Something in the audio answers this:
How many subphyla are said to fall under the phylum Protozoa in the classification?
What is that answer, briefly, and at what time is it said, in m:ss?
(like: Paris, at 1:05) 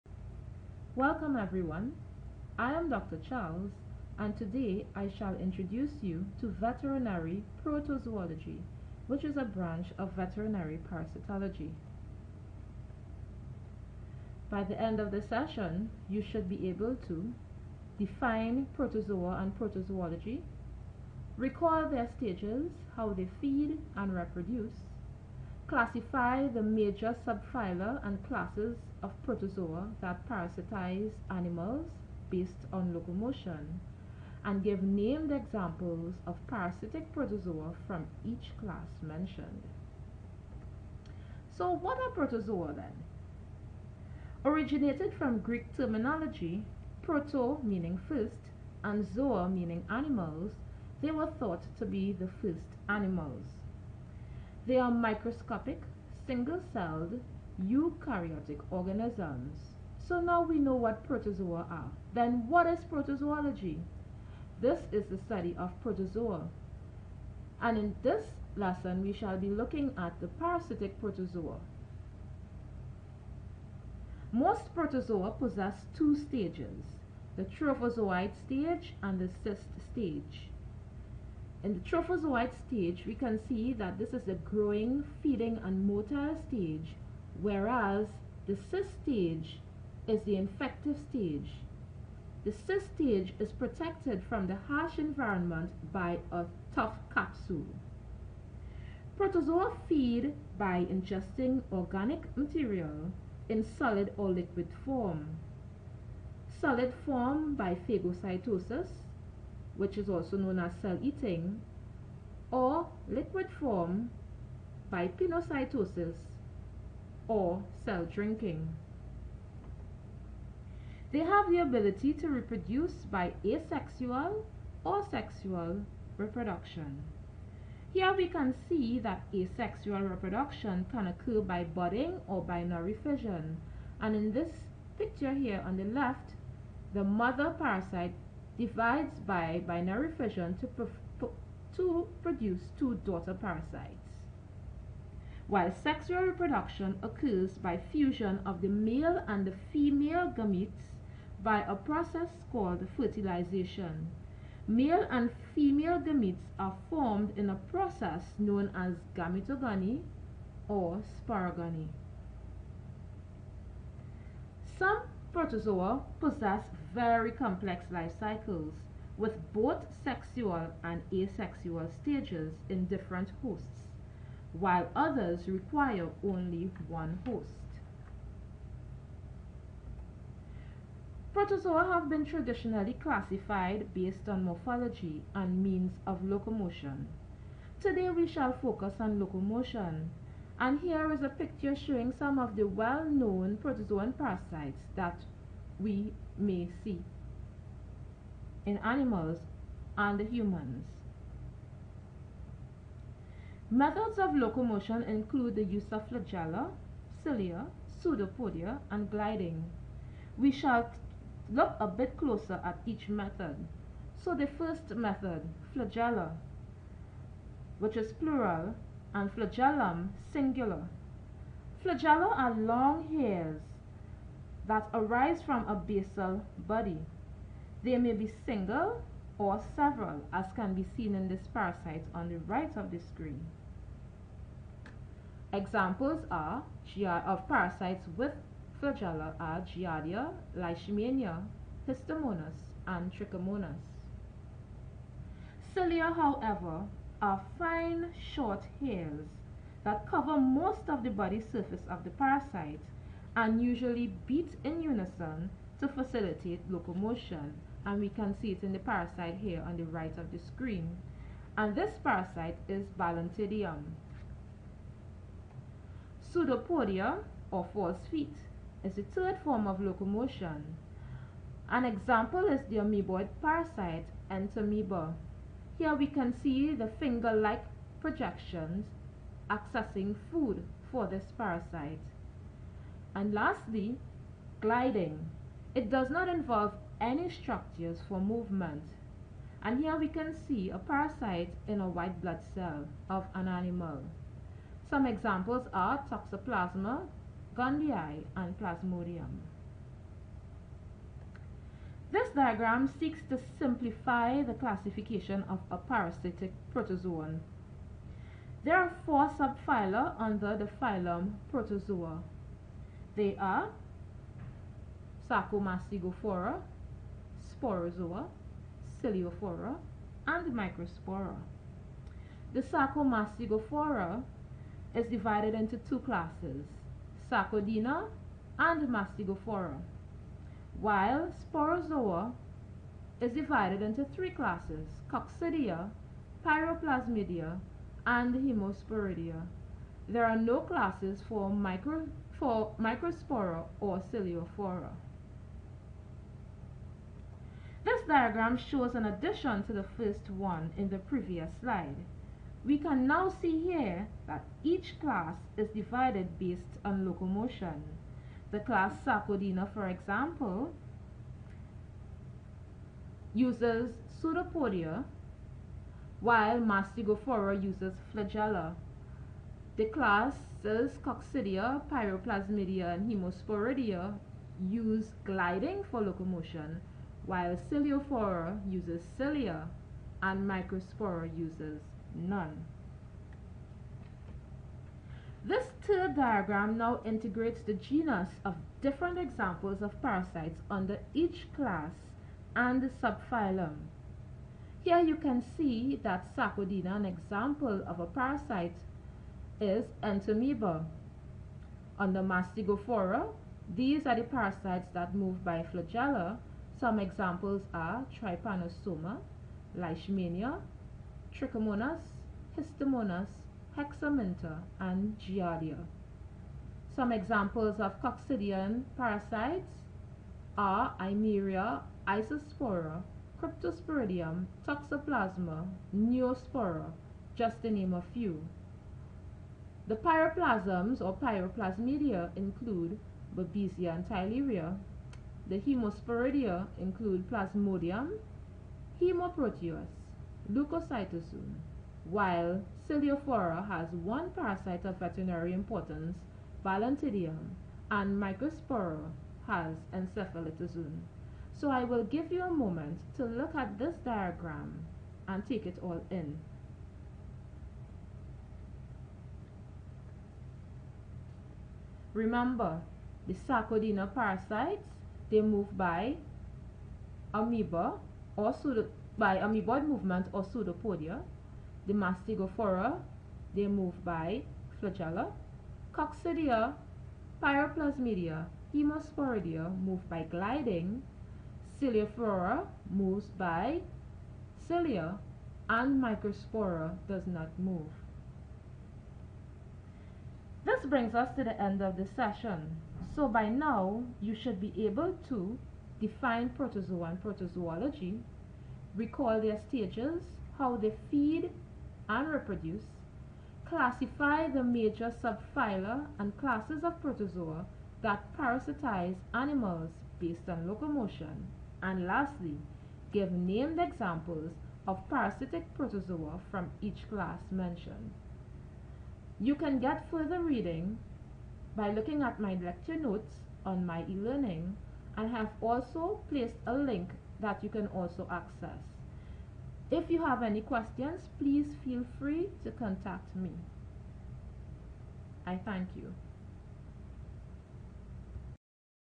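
4, at 5:09.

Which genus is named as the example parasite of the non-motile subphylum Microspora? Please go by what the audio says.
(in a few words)
Encephalitozoon.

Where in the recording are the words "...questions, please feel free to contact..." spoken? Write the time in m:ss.
8:50.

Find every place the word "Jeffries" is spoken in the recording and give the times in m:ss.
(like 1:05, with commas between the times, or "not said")
not said.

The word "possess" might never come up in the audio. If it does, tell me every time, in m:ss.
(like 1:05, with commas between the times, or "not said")
1:15, 2:46.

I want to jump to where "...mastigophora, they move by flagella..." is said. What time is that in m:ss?
7:51.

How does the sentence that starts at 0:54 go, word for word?
They are microscopic, single-celled, eukaryotic organisms.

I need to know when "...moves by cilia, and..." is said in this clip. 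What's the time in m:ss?
8:02.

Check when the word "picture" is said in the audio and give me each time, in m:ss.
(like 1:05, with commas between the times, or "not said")
2:14, 3:11.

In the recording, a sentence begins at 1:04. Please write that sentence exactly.
This is the study of protozoa.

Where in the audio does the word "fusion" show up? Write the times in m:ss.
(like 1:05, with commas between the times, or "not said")
2:27.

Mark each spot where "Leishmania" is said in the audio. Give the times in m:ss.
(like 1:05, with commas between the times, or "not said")
4:00, 6:49.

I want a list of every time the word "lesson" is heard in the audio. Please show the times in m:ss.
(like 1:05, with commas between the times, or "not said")
1:08.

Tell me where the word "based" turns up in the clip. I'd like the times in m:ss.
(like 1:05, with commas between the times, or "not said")
0:32, 3:03, 5:56, 8:30.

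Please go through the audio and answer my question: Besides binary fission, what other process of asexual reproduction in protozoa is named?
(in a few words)
Budding.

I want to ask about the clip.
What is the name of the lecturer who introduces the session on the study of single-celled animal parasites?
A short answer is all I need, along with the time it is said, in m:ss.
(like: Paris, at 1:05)
Dr. Charles, at 0:02.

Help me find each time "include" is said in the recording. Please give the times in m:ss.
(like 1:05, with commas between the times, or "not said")
3:25, 7:12, 7:16.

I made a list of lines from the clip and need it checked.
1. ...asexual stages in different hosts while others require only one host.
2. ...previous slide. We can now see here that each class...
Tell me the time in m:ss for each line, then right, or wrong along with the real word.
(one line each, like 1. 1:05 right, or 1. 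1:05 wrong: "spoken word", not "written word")
1. 2:51 right
2. 5:50 right.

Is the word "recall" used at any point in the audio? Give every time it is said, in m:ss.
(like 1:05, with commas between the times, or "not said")
0:21, 8:18.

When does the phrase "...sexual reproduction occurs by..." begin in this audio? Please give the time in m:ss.
2:25.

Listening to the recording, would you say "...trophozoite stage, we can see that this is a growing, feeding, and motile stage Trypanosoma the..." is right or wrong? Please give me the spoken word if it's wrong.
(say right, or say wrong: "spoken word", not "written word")
wrong: "Whereas", not "Trypanosoma".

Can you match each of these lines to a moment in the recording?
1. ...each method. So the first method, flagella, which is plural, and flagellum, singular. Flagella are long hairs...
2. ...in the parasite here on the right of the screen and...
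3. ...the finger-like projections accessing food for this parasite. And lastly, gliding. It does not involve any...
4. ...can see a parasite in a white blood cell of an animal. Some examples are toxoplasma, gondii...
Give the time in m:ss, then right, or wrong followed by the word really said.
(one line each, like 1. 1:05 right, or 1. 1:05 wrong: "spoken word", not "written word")
1. 3:32 right
2. 4:18 right
3. 4:36 right
4. 4:50 right.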